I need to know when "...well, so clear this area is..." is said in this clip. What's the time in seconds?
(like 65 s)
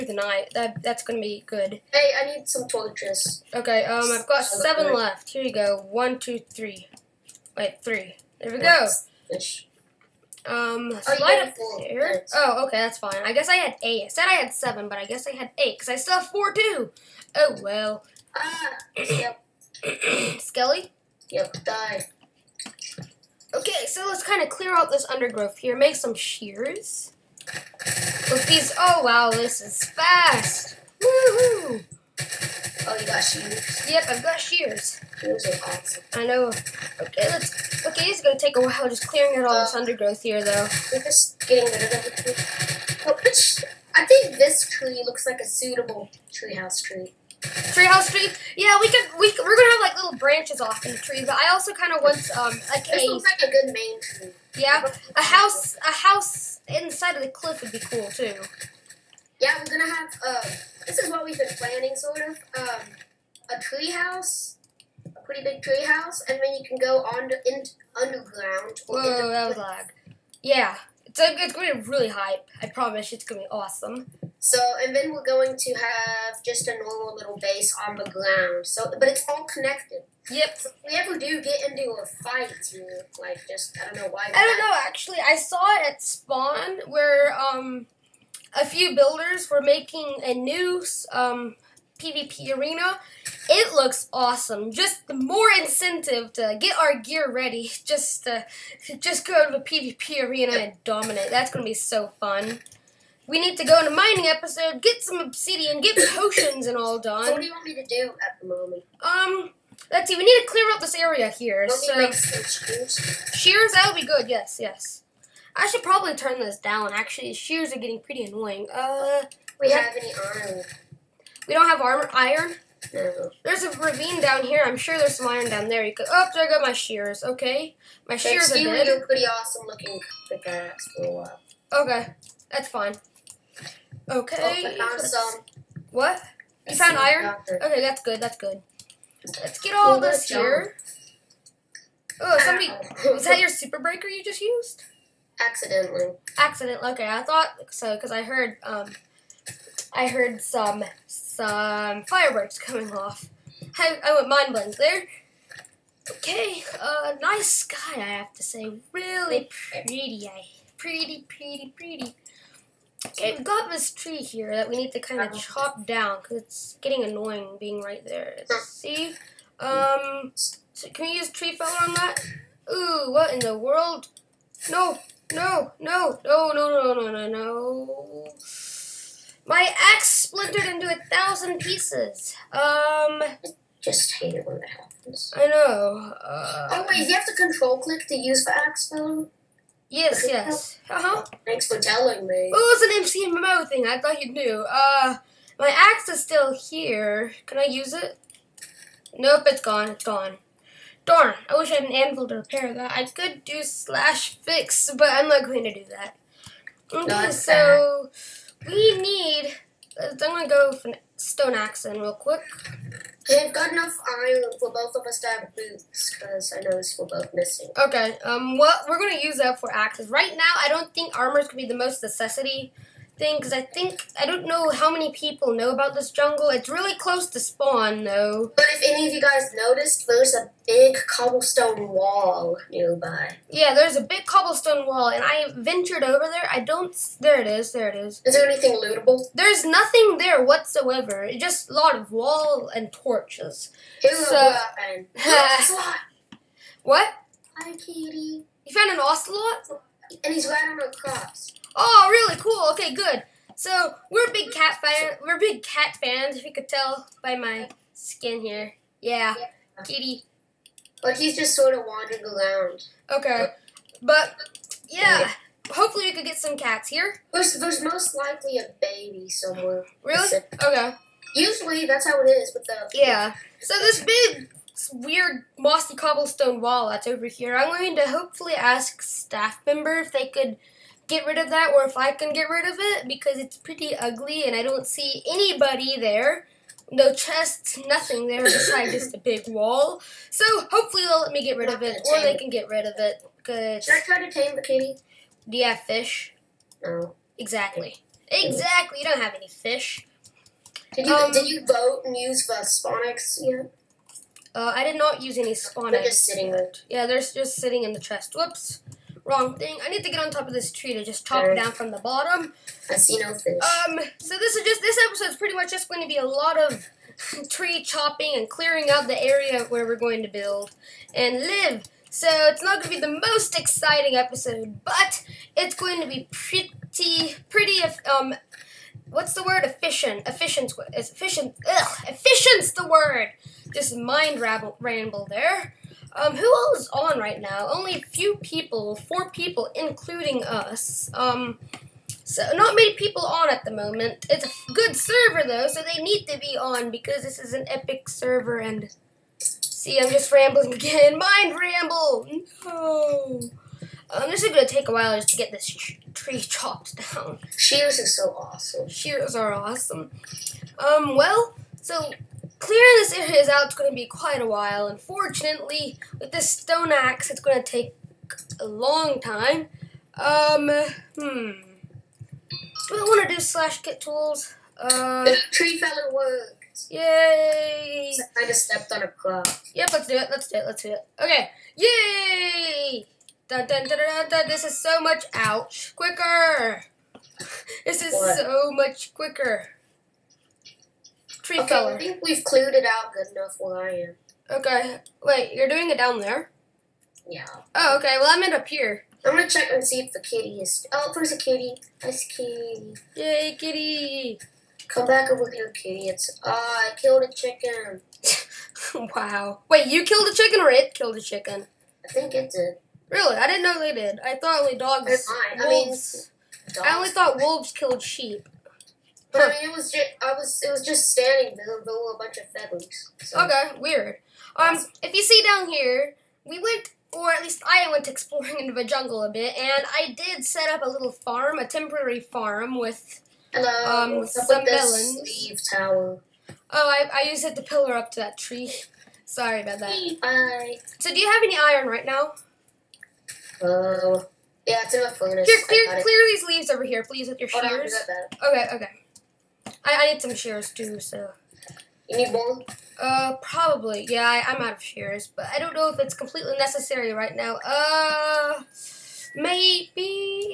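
361 s.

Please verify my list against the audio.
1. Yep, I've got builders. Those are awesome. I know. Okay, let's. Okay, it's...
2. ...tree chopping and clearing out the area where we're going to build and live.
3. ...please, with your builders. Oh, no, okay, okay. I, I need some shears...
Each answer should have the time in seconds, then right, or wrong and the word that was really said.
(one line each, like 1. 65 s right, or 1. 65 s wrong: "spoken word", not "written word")
1. 33 s wrong: "shears", not "builders"
2. 317 s right
3. 447 s wrong: "shears", not "builders".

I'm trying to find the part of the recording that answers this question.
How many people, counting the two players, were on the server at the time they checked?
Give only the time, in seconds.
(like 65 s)
338 s.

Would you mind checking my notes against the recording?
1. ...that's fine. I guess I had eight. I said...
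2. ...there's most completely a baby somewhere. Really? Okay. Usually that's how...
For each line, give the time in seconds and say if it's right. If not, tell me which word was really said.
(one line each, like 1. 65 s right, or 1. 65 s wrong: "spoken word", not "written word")
1. 12 s right
2. 267 s wrong: "likely", not "completely".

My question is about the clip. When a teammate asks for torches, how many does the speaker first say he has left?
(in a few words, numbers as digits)
7.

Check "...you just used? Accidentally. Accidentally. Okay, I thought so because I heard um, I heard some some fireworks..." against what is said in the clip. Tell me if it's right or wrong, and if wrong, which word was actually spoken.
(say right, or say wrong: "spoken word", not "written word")
right.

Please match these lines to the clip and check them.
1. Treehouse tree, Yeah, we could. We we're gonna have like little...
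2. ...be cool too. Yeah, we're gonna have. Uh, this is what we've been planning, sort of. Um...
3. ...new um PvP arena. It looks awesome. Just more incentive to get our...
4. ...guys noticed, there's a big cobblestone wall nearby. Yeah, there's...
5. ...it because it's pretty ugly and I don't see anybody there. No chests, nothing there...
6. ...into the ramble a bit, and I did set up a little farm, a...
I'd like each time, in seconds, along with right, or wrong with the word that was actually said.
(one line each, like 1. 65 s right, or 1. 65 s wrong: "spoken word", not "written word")
1. 47 s right
2. 57 s right
3. 90 s right
4. 229 s right
5. 282 s right
6. 428 s wrong: "jungle", not "ramble".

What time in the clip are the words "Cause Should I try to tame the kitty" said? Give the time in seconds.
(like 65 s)
293 s.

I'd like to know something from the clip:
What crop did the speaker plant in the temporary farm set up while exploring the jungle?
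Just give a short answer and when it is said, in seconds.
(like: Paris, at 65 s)
Melons, at 434 s.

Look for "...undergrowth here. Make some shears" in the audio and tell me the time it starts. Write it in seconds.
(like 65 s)
25 s.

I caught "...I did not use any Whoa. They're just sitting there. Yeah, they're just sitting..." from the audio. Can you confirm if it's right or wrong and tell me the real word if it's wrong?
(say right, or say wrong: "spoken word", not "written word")
wrong: "Sponics", not "Whoa".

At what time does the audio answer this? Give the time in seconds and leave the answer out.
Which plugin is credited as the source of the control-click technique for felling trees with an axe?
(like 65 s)
193 s.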